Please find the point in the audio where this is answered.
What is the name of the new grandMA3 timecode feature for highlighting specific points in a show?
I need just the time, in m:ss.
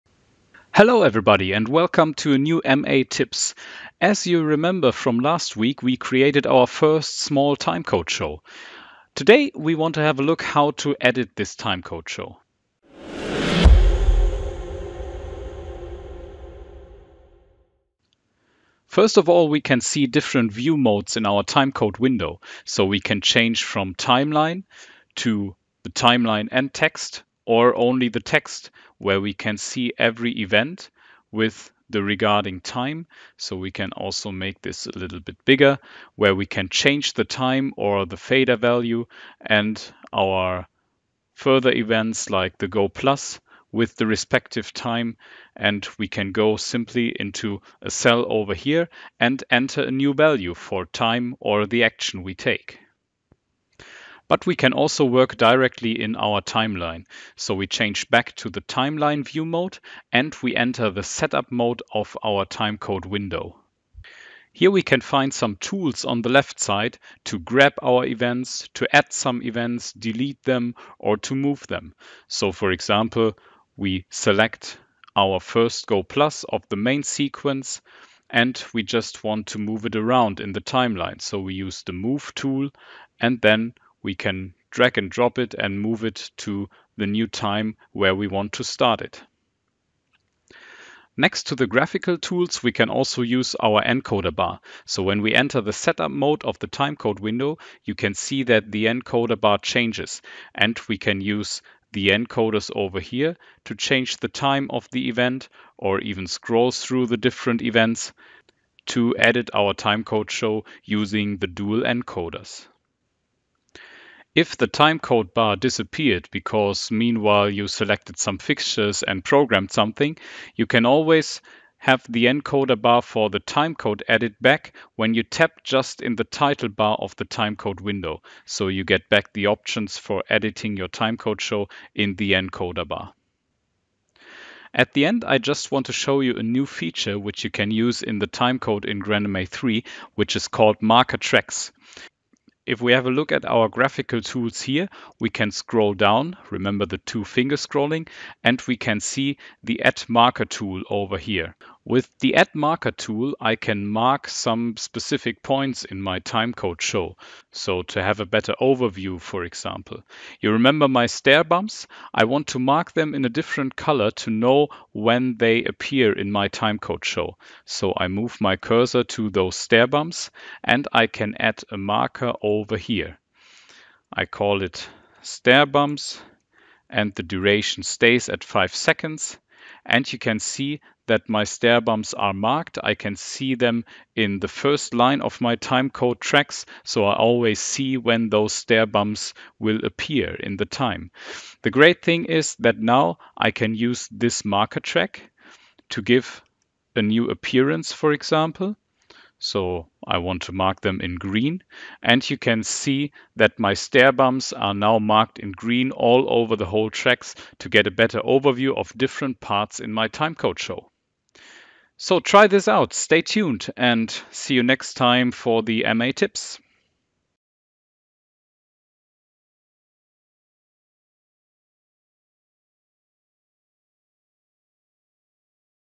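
2:20.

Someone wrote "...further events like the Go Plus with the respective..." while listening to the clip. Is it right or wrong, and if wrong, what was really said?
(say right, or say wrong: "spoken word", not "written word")
right.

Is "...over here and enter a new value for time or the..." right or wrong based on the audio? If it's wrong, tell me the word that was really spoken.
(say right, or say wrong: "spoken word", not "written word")
right.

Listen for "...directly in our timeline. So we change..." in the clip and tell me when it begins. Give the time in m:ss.
0:55.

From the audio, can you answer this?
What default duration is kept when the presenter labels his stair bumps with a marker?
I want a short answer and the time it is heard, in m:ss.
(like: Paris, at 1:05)
5 seconds, at 2:58.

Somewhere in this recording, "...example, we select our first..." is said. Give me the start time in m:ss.
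1:12.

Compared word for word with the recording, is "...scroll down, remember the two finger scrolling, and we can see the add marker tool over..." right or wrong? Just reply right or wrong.
right.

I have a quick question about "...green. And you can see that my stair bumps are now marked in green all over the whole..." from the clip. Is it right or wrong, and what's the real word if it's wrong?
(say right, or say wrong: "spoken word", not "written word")
right.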